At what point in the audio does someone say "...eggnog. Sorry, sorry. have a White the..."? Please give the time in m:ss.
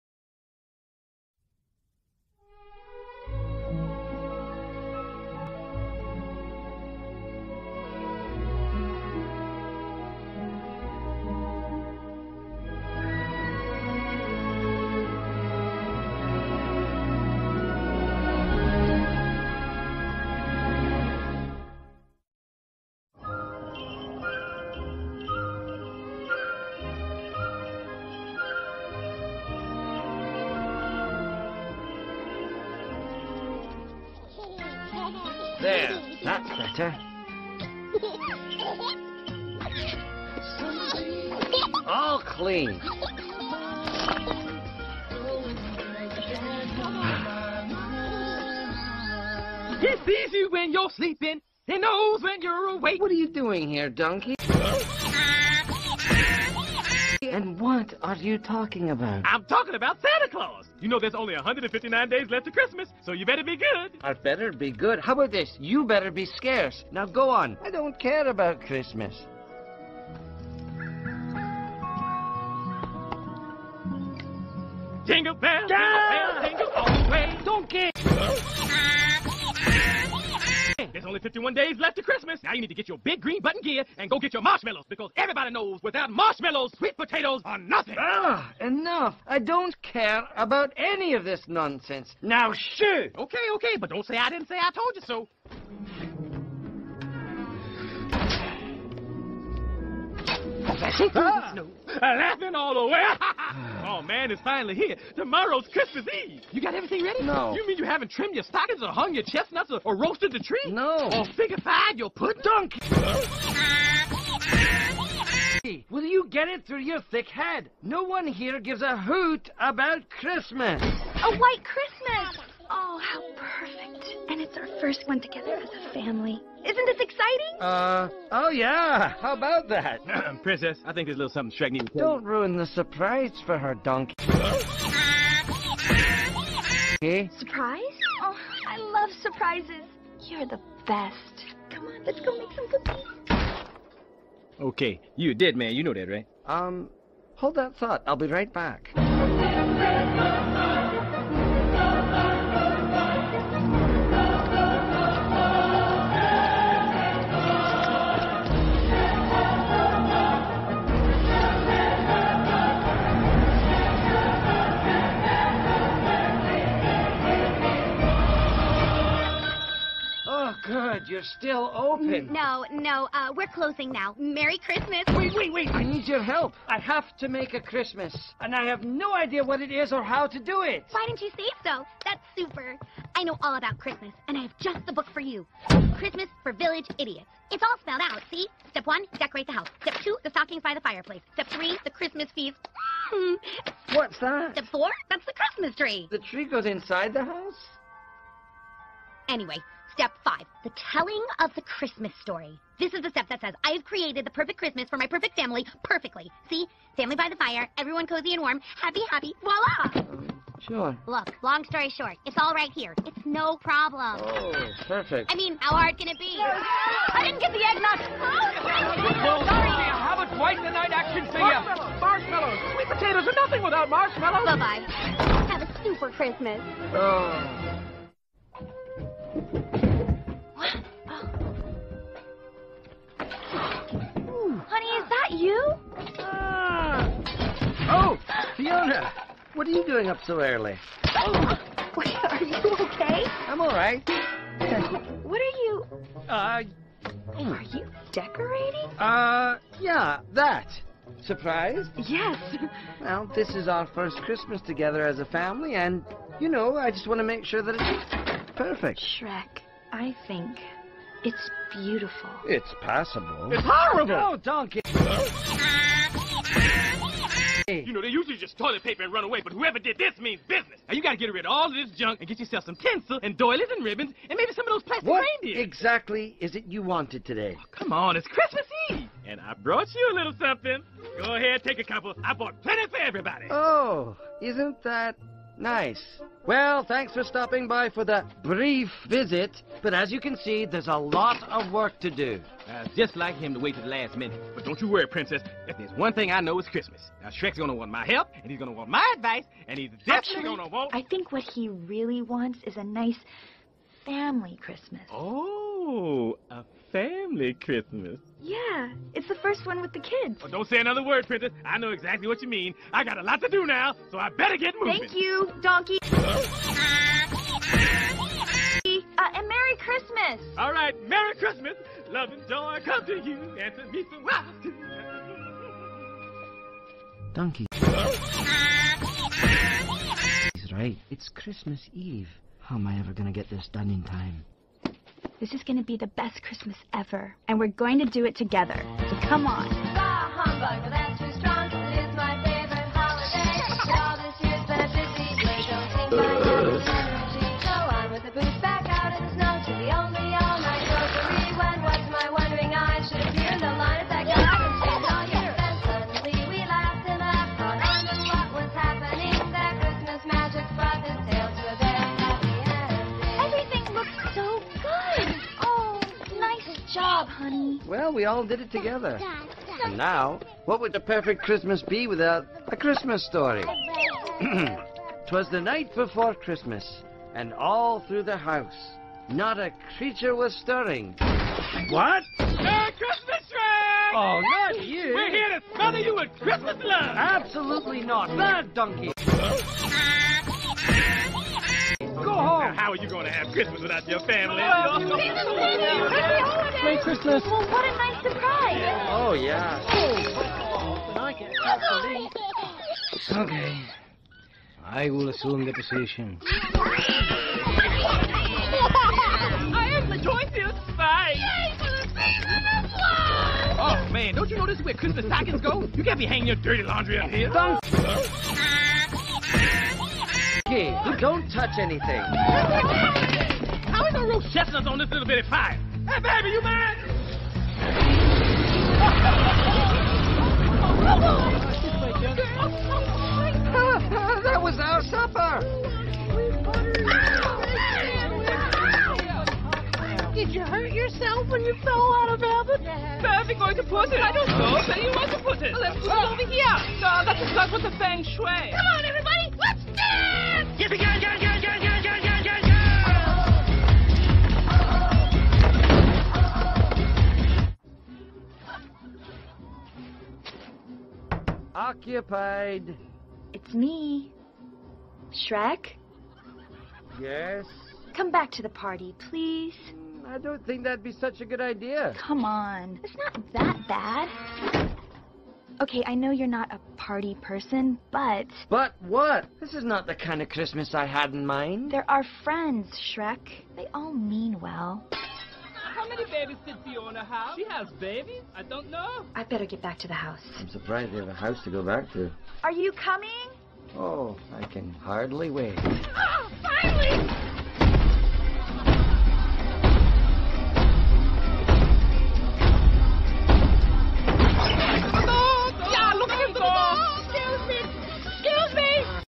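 3:37.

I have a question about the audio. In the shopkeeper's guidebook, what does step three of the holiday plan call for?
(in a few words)
The Christmas feast.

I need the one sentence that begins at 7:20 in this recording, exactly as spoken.
Did you hurt yourself when you fell out of heaven?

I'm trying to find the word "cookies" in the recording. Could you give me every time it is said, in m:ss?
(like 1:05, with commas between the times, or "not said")
2:22.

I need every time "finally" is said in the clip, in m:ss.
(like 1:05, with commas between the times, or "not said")
1:44, 8:16.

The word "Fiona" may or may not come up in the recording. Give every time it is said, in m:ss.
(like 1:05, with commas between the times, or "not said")
3:58, 8:06.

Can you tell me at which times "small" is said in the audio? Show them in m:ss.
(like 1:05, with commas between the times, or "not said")
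not said.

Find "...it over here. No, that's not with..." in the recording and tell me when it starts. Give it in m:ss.
7:26.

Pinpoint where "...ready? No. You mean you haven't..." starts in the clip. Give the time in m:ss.
1:47.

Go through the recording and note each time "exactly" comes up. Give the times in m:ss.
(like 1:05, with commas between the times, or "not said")
4:35, 5:11.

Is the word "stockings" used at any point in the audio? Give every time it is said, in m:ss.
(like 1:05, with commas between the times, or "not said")
1:48, 3:10, 6:55.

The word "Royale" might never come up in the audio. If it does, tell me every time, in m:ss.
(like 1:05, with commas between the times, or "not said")
not said.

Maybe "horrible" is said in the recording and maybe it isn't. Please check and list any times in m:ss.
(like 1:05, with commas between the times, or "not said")
4:23.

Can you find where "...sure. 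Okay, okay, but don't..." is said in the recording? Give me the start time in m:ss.
1:32.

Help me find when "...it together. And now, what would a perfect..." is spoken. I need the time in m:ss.
6:08.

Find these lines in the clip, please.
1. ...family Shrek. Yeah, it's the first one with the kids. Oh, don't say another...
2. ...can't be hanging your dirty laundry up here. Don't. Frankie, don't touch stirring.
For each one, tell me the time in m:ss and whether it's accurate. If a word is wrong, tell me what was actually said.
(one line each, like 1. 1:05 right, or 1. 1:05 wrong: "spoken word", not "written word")
1. 5:06 wrong: "Christmas", not "Shrek"
2. 6:56 wrong: "anything", not "stirring".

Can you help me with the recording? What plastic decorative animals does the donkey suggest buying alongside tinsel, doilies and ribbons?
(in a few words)
Reindeer.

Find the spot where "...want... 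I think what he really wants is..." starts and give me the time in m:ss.
5:00.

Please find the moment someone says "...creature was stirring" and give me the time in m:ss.
6:19.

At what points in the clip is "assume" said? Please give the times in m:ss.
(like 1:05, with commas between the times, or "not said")
6:45.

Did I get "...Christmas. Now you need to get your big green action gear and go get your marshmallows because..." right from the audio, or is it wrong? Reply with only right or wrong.
wrong.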